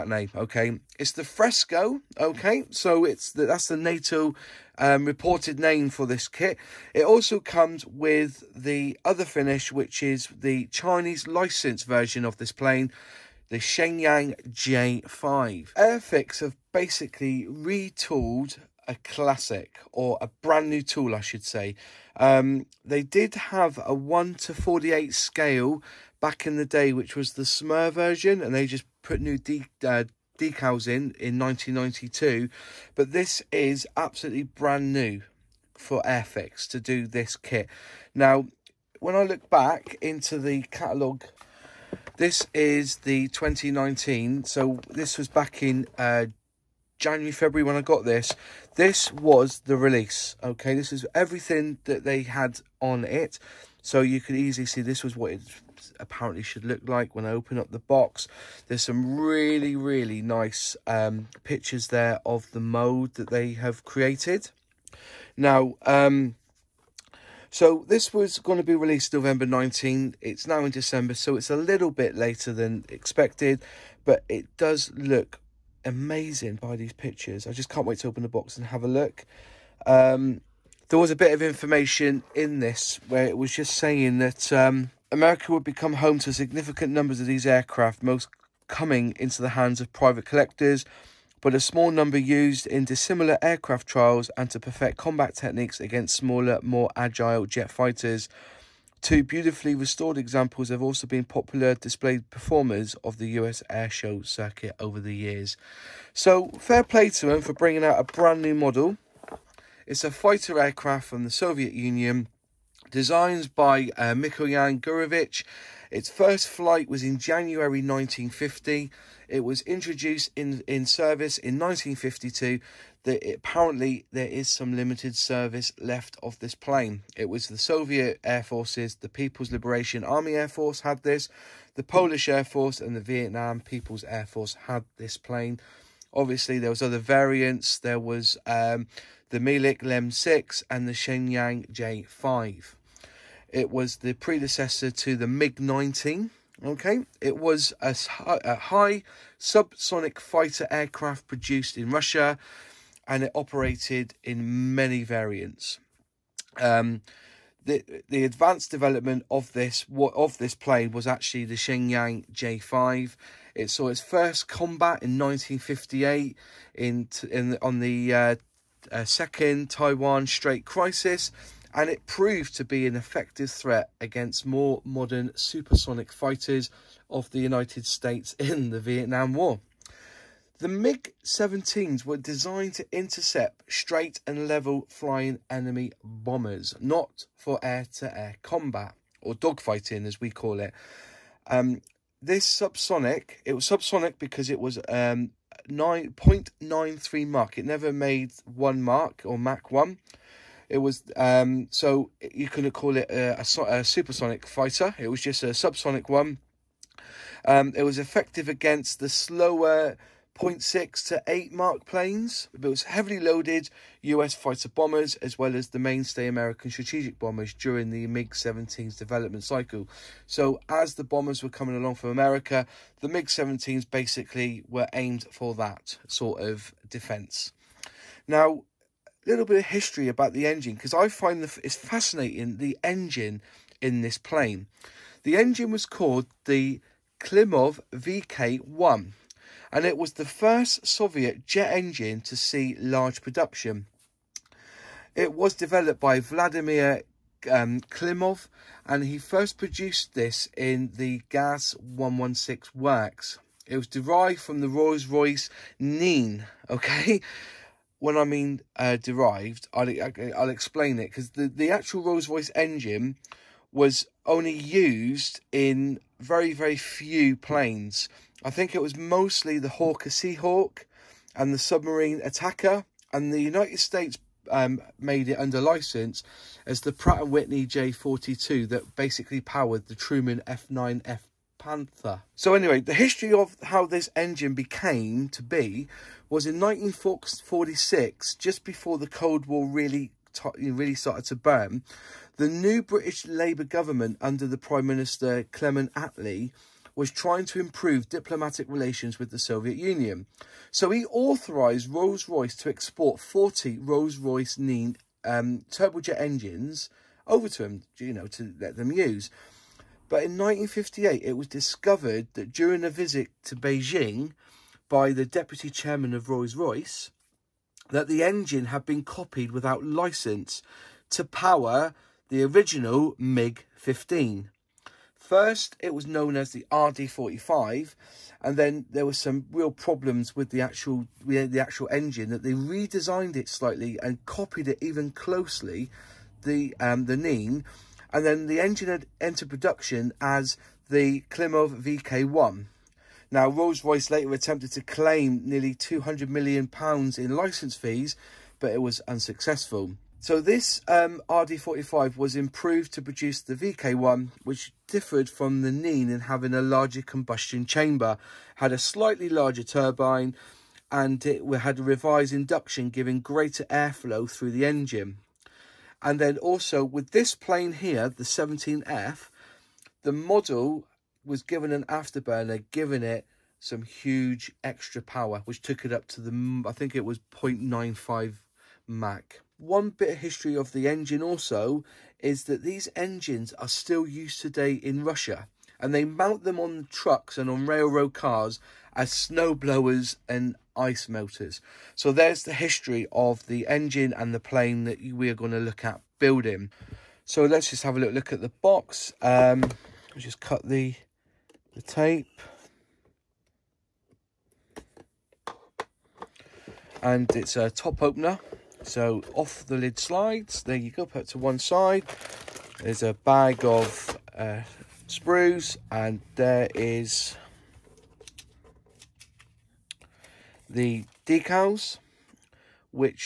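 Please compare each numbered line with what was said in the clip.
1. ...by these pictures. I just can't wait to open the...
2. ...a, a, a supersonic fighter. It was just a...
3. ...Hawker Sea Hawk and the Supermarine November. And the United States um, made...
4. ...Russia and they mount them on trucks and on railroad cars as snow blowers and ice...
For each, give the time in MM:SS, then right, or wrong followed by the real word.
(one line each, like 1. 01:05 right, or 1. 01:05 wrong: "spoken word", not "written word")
1. 01:16 right
2. 03:23 right
3. 04:29 wrong: "Attacker", not "November"
4. 06:25 right.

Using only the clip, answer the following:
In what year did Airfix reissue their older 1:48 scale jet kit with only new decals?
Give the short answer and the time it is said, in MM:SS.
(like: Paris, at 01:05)
1992, at 00:31.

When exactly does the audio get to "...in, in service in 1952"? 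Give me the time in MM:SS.
02:00.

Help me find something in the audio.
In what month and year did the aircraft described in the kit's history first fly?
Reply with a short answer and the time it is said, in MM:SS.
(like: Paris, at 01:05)
January 1950, at 01:57.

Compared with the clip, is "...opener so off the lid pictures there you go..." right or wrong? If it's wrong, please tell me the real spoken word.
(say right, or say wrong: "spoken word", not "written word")
wrong: "slides", not "pictures".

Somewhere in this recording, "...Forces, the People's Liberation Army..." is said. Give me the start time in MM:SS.
02:08.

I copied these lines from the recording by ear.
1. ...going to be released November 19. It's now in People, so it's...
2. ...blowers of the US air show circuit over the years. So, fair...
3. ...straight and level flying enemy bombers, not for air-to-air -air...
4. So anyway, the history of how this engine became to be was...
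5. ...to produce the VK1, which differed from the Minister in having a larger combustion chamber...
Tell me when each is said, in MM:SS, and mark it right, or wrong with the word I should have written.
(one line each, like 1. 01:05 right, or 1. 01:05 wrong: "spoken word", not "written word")
1. 01:08 wrong: "December", not "People"
2. 01:42 wrong: "performers", not "blowers"
3. 03:03 right
4. 04:42 right
5. 05:52 wrong: "Nene", not "Minister".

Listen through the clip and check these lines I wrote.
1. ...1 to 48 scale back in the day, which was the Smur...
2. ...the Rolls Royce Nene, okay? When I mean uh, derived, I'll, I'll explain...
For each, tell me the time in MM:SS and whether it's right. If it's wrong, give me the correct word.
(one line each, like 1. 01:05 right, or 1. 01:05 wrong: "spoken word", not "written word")
1. 00:23 right
2. 04:14 right.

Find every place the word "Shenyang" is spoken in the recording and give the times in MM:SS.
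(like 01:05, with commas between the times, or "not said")
00:13, 02:20, 02:41.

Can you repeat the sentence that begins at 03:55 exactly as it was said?
The engine was called the Klimov VK 1 and it was the first Soviet jet engine to see large production.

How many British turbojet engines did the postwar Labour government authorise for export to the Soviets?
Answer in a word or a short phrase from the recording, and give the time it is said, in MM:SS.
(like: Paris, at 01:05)
40, at 05:03.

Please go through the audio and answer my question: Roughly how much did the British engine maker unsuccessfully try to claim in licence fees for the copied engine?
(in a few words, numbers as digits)
£200 million.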